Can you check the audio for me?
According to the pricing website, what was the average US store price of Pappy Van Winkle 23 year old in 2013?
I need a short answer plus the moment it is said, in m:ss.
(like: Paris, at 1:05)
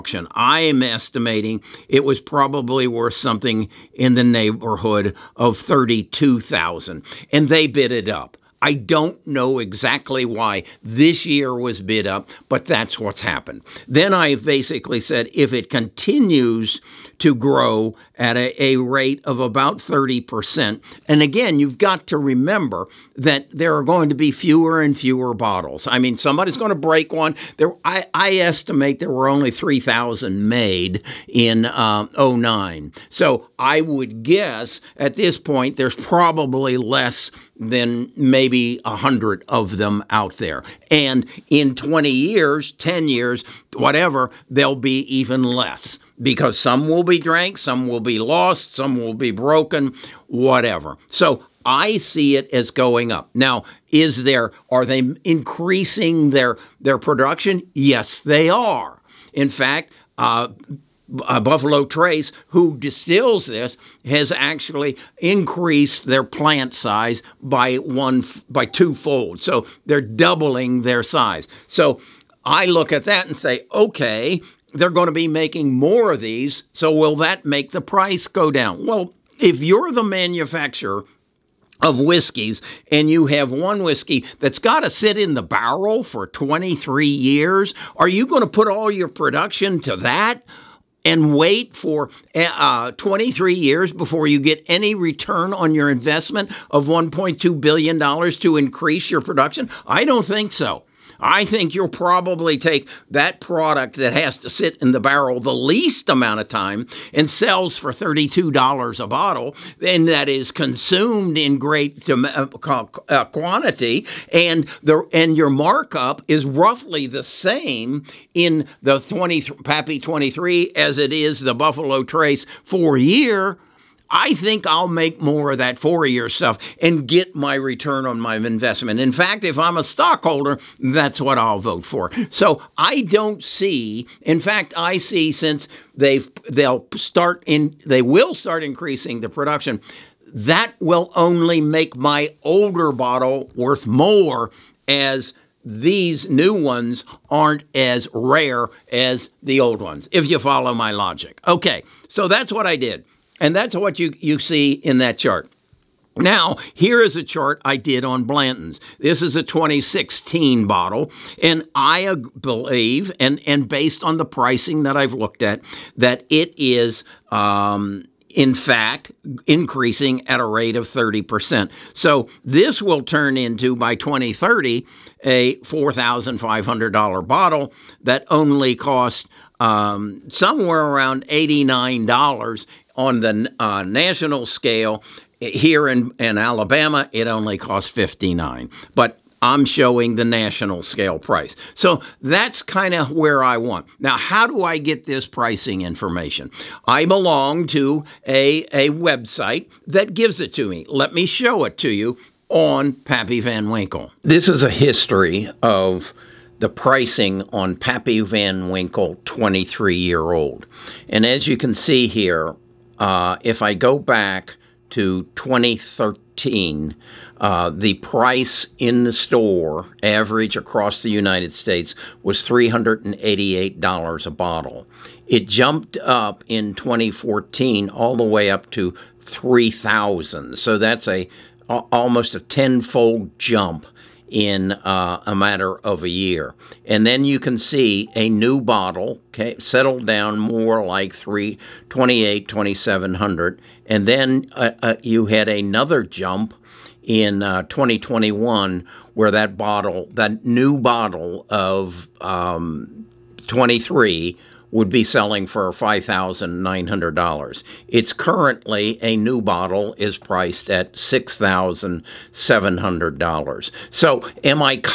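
$388, at 3:42.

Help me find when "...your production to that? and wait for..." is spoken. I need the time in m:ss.
1:28.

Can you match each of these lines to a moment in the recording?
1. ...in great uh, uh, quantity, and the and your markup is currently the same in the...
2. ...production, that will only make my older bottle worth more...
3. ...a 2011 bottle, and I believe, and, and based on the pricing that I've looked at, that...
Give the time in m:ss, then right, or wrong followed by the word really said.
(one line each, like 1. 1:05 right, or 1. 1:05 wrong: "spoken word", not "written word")
1. 1:51 wrong: "roughly", not "currently"
2. 2:19 right
3. 2:39 wrong: "2016", not "2011".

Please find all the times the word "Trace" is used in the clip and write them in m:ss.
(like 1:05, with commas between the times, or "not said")
1:01, 2:02.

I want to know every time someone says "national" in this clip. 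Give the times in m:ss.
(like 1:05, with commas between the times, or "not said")
3:03, 3:10.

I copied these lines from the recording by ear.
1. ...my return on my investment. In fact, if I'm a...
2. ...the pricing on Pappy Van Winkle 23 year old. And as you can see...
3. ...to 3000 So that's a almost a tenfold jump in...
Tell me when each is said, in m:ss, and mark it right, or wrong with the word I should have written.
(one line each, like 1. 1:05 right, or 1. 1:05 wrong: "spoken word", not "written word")
1. 2:07 right
2. 3:26 right
3. 3:48 right.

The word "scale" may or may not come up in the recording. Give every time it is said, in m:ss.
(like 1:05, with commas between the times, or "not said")
3:04, 3:10.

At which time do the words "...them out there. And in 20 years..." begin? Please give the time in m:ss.
0:39.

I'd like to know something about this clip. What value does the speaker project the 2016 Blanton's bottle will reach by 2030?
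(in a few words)
$4,500.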